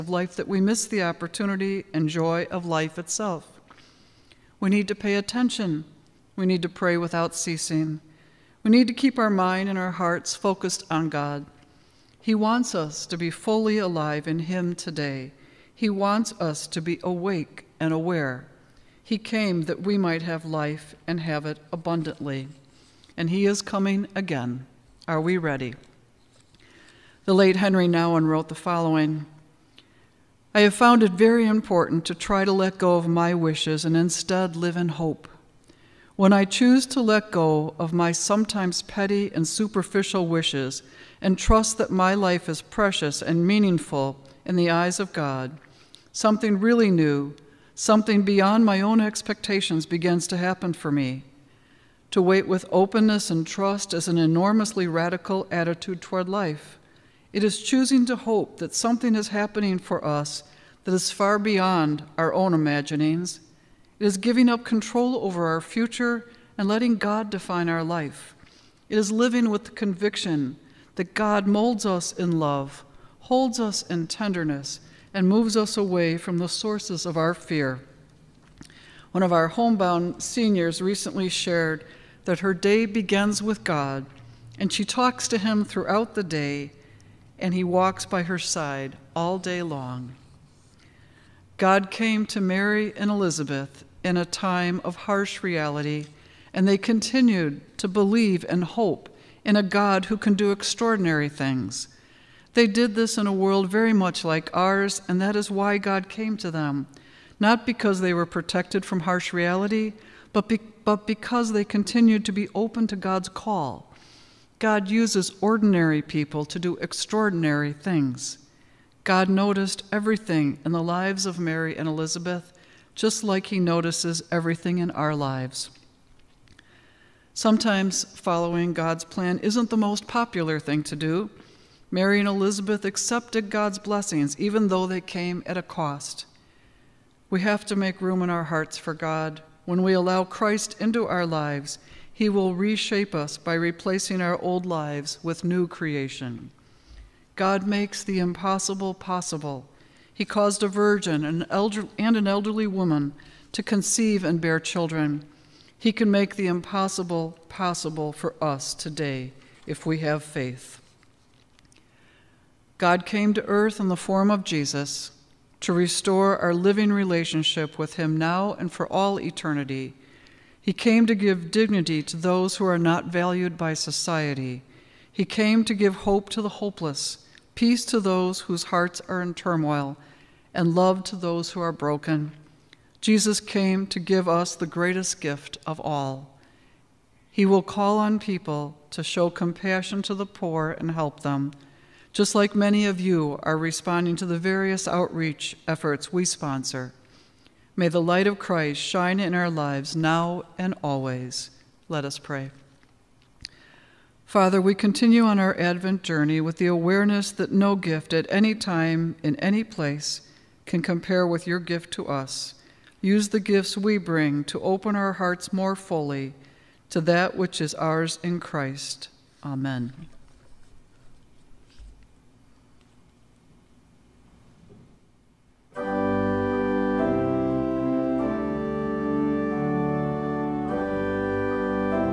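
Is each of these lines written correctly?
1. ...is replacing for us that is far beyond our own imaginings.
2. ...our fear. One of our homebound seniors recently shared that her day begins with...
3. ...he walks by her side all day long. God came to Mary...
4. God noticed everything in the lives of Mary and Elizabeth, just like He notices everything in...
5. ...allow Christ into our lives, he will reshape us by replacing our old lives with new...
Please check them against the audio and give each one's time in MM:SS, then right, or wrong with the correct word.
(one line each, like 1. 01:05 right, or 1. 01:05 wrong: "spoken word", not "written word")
1. 00:59 wrong: "happening", not "replacing"
2. 01:17 right
3. 01:27 right
4. 01:59 right
5. 02:19 right.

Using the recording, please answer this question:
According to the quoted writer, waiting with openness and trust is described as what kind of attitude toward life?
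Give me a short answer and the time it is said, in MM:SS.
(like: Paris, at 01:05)
enormously radical, at 00:54.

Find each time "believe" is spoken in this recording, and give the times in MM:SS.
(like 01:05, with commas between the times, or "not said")
01:37.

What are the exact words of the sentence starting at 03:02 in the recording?
Jesus came to give us the greatest gift of all.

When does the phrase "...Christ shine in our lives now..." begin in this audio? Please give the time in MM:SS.
03:18.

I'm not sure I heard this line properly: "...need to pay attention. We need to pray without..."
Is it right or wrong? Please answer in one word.
right.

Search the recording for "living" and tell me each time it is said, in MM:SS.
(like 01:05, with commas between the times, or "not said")
01:09, 02:46.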